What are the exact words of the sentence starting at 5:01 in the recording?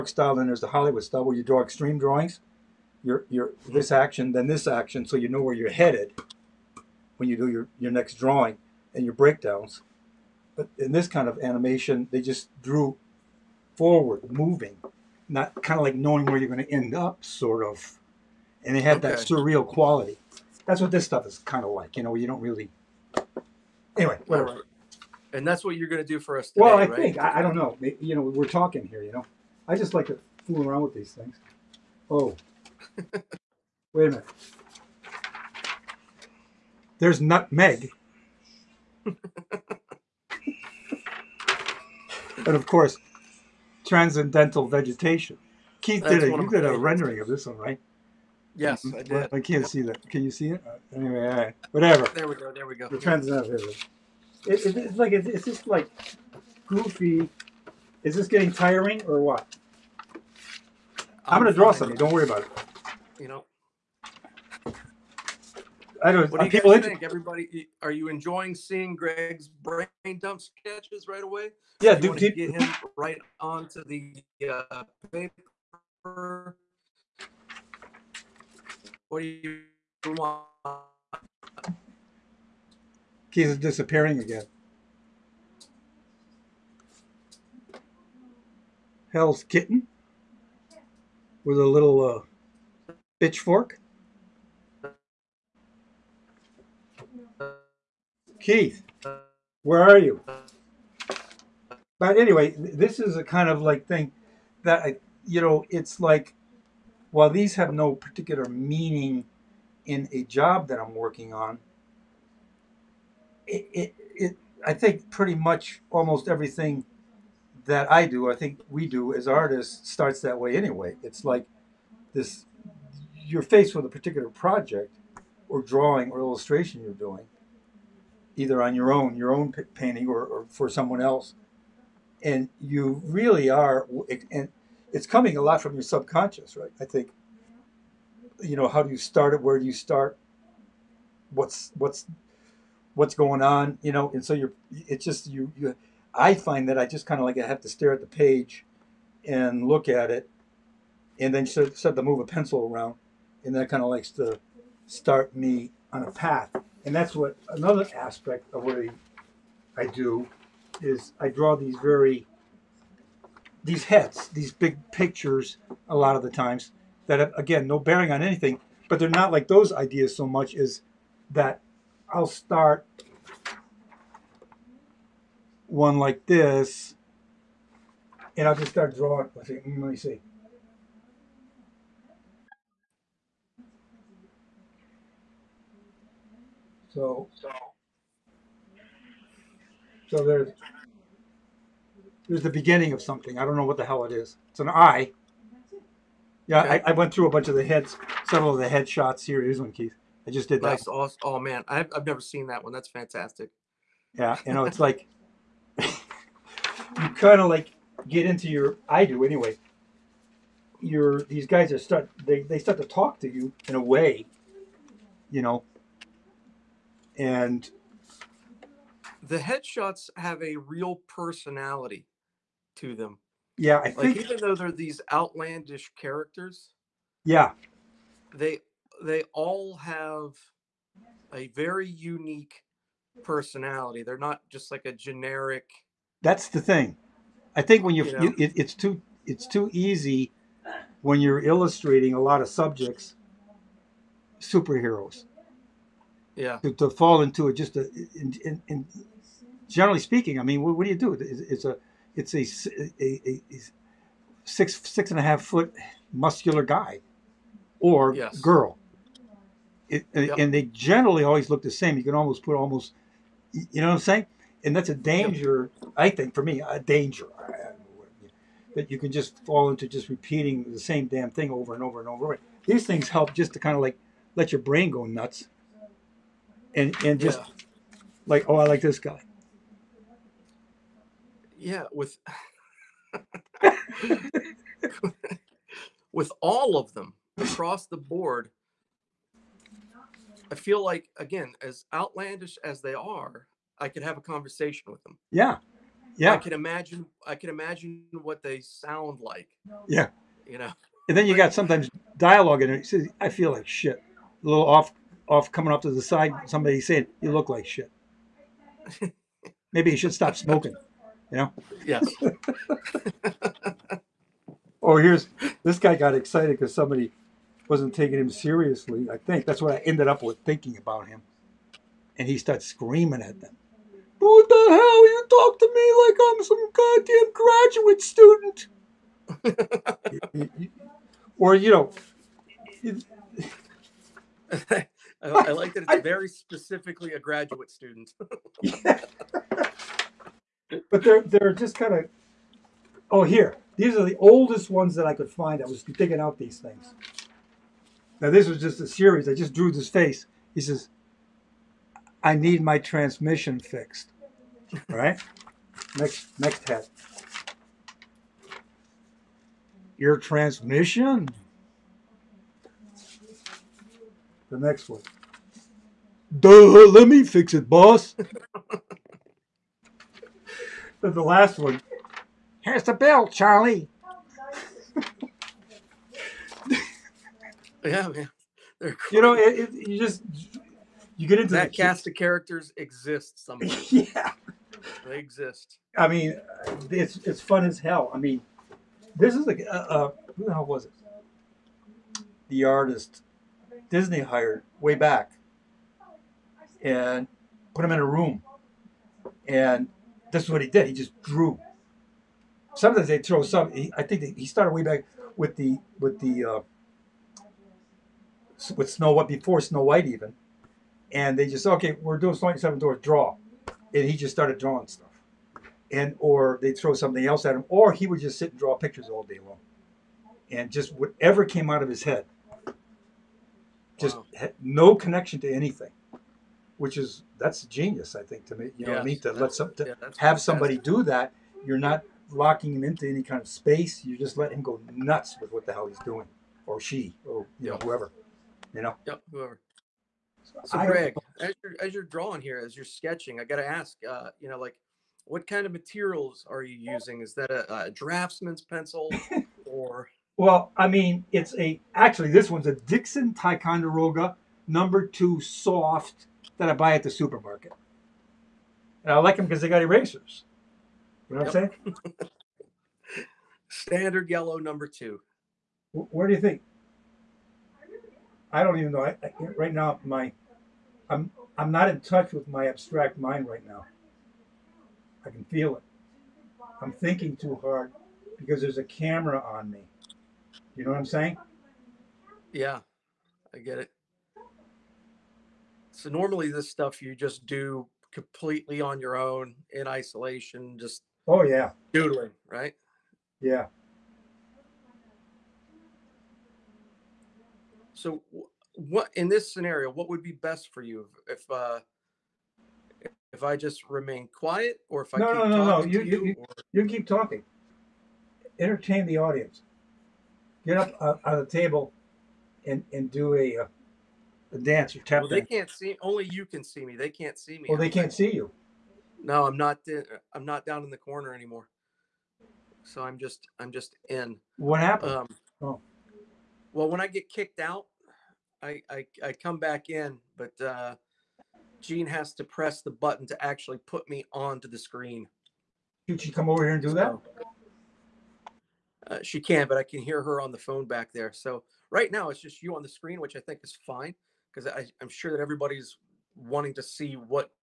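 And then you got sometimes dialogue in it.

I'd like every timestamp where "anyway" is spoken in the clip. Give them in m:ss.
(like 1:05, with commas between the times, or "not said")
0:23, 0:50, 1:42, 2:00, 3:29.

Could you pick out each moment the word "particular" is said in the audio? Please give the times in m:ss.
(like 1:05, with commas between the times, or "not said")
1:47, 2:03.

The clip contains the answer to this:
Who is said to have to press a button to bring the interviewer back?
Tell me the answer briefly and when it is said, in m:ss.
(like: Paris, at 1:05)
Jean, at 8:51.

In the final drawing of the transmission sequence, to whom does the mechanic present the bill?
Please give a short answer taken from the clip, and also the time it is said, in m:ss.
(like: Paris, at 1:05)
Charlie, at 6:13.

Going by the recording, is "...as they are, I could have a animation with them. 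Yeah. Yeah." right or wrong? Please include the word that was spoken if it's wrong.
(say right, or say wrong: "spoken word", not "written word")
wrong: "conversation", not "animation".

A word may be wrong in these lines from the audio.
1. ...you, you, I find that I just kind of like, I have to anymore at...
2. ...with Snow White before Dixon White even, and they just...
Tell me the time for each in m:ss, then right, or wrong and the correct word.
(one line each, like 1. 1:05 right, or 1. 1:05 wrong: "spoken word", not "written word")
1. 2:25 wrong: "stare", not "anymore"
2. 6:48 wrong: "Snow", not "Dixon".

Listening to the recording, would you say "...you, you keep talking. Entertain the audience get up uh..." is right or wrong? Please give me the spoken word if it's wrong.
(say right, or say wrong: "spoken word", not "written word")
right.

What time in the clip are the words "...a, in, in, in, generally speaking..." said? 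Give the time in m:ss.
4:07.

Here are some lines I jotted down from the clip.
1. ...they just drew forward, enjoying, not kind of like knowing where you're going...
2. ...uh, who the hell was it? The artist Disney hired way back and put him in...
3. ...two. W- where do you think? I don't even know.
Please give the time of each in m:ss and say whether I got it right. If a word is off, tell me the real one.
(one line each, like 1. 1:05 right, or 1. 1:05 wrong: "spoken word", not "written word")
1. 0:12 wrong: "moving", not "enjoying"
2. 6:29 right
3. 7:44 right.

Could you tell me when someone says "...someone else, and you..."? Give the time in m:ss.
2:10.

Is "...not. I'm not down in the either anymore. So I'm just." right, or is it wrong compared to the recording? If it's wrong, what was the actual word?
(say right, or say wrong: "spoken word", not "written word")
wrong: "corner", not "either".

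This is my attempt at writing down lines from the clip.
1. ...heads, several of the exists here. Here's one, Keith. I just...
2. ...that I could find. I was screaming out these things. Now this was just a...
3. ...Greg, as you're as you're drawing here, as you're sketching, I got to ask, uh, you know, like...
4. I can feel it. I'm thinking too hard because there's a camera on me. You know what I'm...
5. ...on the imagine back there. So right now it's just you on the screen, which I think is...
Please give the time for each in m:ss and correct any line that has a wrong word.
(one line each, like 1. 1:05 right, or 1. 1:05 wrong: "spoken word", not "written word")
1. 3:17 wrong: "headshots", not "exists"
2. 5:44 wrong: "digging", not "screaming"
3. 7:20 right
4. 7:55 right
5. 9:00 wrong: "phone", not "imagine".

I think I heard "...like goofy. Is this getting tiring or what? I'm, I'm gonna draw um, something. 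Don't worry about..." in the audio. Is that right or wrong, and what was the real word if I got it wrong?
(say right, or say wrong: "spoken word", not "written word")
right.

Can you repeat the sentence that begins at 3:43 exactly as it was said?
Yeah, I like think even though they're these outlandish characters, yeah, they they all have a very unique personality.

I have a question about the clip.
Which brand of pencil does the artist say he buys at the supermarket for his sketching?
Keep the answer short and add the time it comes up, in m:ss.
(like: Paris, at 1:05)
Dixon Ticonderoga, at 7:32.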